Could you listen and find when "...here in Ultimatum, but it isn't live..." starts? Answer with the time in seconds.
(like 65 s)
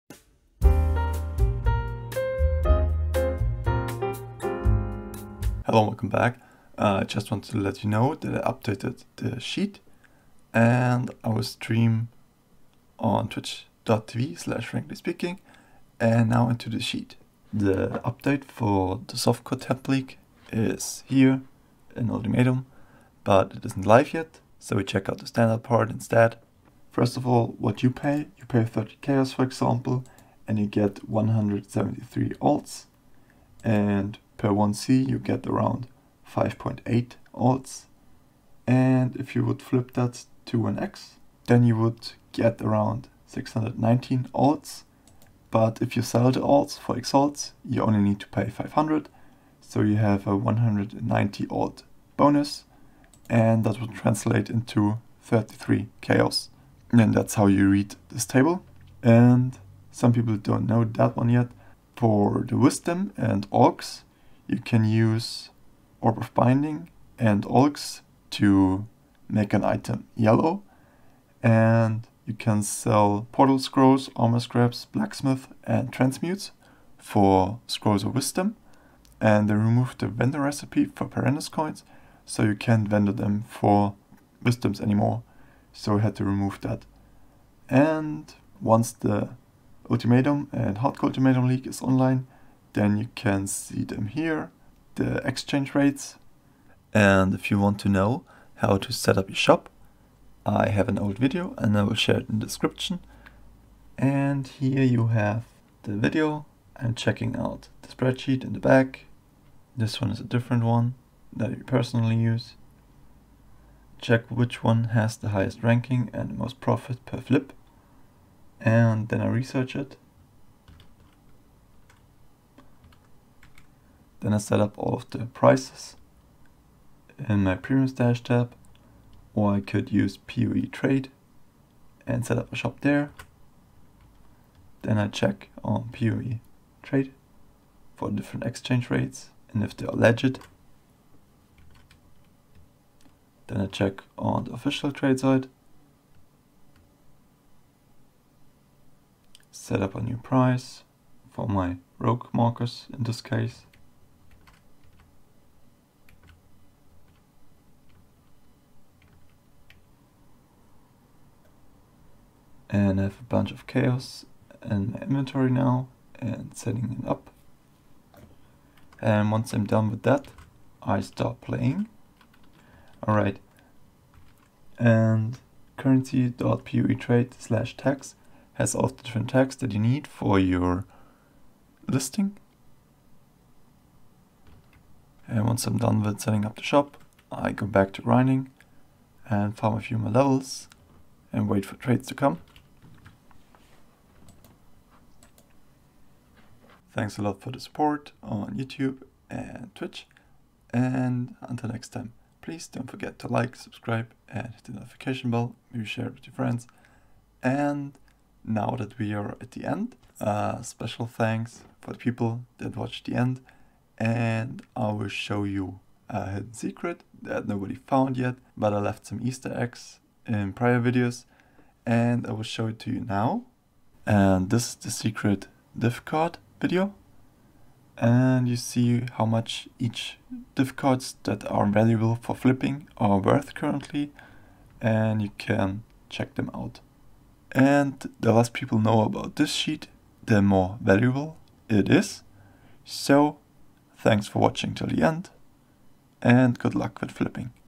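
21 s.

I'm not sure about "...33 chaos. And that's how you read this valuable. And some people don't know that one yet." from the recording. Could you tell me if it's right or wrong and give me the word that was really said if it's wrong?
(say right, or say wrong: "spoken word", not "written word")
wrong: "table", not "valuable".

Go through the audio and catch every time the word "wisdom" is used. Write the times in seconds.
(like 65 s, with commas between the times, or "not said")
62 s, 78 s, 84 s.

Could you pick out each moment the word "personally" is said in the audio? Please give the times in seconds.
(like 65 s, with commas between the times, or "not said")
111 s.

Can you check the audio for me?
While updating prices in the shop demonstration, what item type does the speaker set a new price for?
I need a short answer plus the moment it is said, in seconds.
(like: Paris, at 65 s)
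rogue markers, at 151 s.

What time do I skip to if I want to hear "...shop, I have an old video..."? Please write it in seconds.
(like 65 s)
99 s.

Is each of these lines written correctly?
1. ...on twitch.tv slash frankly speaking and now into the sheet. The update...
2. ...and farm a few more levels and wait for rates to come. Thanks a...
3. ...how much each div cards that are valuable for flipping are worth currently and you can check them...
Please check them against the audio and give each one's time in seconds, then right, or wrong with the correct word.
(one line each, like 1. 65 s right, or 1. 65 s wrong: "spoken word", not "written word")
1. 12 s right
2. 189 s wrong: "trades", not "rates"
3. 229 s right.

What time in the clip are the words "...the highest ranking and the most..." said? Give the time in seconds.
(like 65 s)
115 s.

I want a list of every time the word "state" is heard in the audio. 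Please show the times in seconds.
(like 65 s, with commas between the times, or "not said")
not said.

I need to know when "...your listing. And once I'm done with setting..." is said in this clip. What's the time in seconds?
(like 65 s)
180 s.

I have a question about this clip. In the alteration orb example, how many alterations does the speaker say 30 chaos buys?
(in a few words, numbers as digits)
173.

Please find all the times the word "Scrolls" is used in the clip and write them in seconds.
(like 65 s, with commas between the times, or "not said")
73 s, 77 s.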